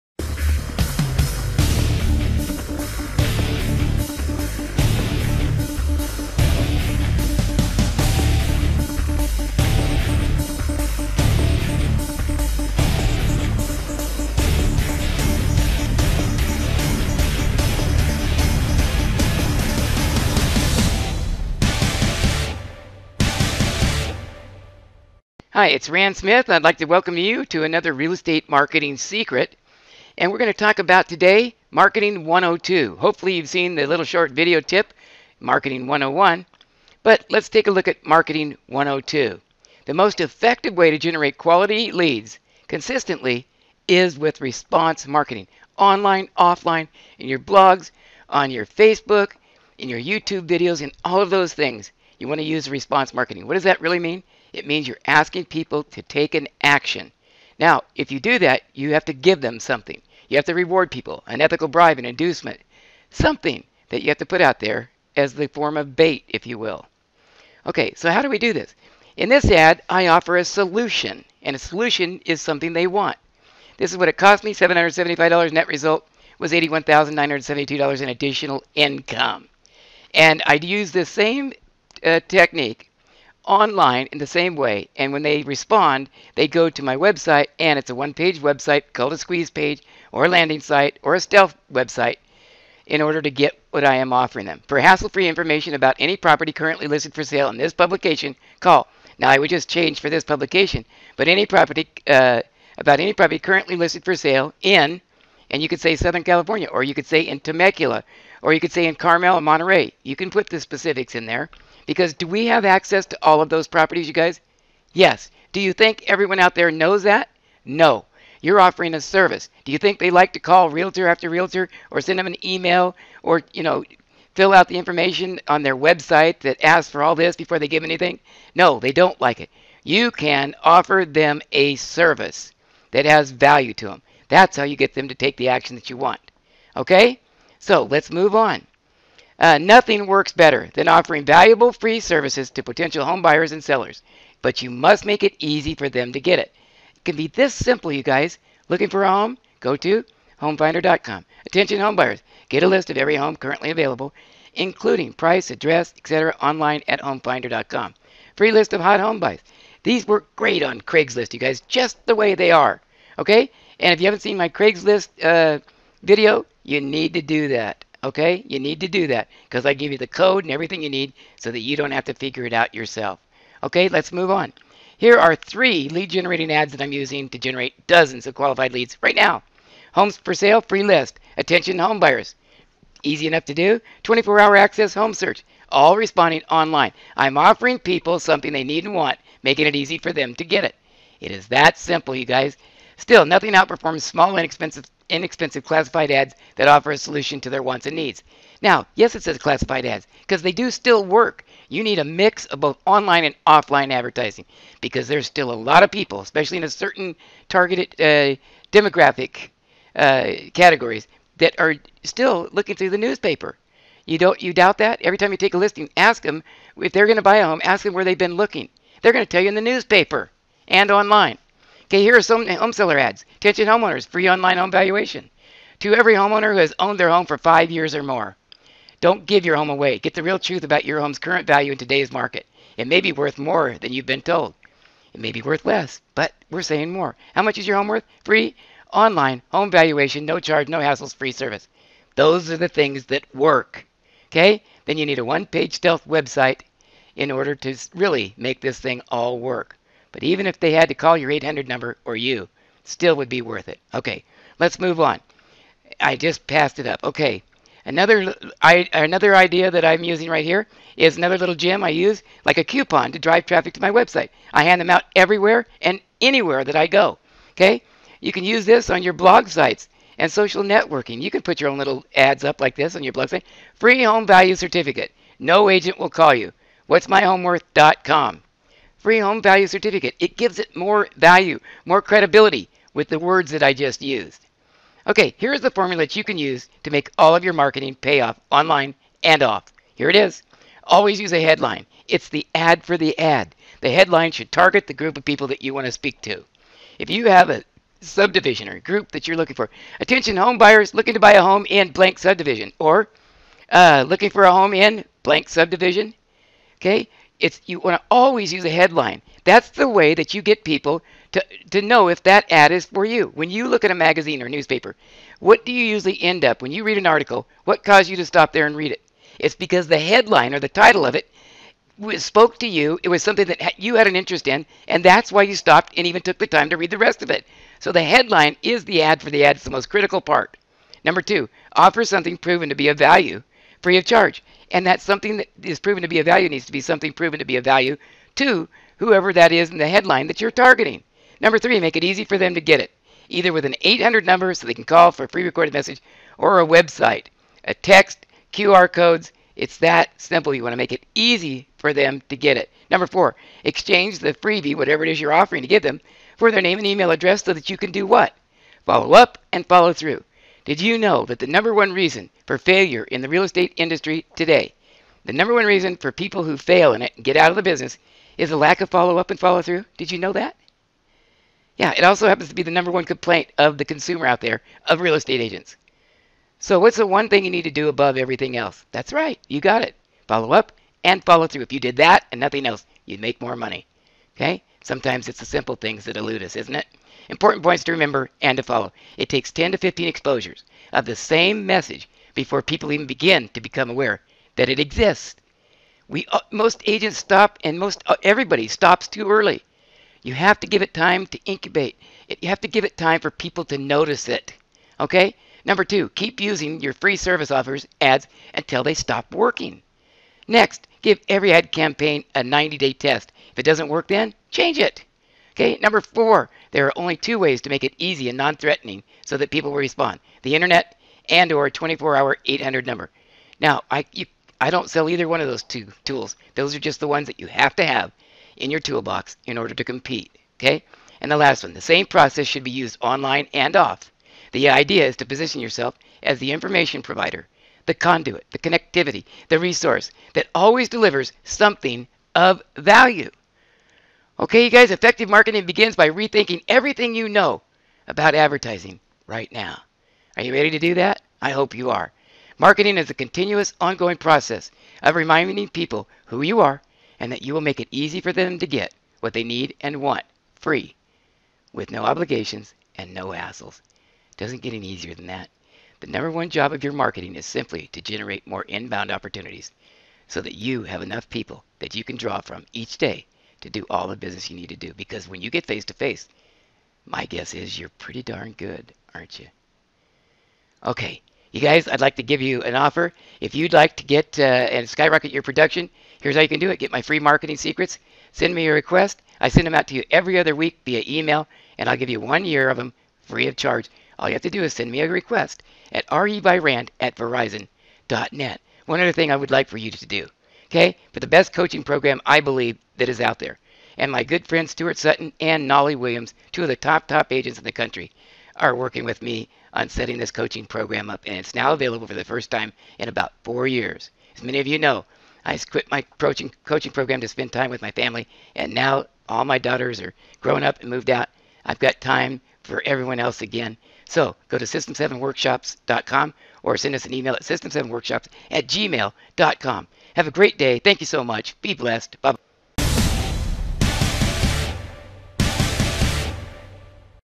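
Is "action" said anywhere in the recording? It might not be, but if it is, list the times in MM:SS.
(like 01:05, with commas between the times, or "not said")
00:56, 02:15.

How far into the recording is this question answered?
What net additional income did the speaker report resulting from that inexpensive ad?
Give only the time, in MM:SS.
01:16.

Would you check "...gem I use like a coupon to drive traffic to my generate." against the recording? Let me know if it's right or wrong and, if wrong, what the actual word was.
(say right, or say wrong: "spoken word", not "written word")
wrong: "website", not "generate".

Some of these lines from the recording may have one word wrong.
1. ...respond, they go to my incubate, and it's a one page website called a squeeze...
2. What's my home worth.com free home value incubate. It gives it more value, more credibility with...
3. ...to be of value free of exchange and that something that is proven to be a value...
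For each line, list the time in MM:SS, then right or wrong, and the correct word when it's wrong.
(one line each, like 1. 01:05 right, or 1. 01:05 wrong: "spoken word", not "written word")
1. 01:25 wrong: "website", not "incubate"
2. 04:36 wrong: "certificate", not "incubate"
3. 05:32 wrong: "charge", not "exchange".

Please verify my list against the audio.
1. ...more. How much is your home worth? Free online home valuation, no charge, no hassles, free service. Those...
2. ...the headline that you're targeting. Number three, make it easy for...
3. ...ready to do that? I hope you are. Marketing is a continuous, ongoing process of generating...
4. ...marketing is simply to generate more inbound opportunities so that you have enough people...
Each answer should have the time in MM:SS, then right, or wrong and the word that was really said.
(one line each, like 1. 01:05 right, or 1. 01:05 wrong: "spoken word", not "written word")
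1. 03:56 right
2. 05:39 right
3. 07:30 wrong: "reminding", not "generating"
4. 07:46 right.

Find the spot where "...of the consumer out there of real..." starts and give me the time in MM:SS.
06:13.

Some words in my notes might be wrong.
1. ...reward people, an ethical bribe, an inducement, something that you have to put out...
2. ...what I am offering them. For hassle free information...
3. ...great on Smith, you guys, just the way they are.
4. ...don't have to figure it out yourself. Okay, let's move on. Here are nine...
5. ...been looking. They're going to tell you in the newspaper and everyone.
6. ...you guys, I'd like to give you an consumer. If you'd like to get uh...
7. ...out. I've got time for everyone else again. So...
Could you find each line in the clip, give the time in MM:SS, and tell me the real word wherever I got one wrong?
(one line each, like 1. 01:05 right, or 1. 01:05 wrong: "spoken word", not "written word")
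1. 01:00 right
2. 01:33 right
3. 02:40 wrong: "Craigslist", not "Smith"
4. 02:51 wrong: "three", not "nine"
5. 03:38 wrong: "online", not "everyone"
6. 08:01 wrong: "offer", not "consumer"
7. 08:41 right.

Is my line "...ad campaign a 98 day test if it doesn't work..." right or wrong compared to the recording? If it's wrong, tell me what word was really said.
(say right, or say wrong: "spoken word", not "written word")
wrong: "90", not "98".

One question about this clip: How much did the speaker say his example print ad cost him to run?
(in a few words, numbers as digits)
$775.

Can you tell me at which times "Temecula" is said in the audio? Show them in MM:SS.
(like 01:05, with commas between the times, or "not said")
01:47.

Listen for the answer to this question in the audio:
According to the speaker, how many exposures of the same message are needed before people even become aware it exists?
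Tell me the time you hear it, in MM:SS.
06:29.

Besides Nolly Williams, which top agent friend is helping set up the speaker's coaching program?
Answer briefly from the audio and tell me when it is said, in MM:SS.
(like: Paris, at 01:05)
Stuart Sutton, at 08:24.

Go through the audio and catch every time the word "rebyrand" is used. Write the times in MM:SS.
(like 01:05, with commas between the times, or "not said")
08:16.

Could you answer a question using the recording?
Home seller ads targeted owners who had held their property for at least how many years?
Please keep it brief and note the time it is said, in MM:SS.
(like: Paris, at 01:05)
5, at 03:47.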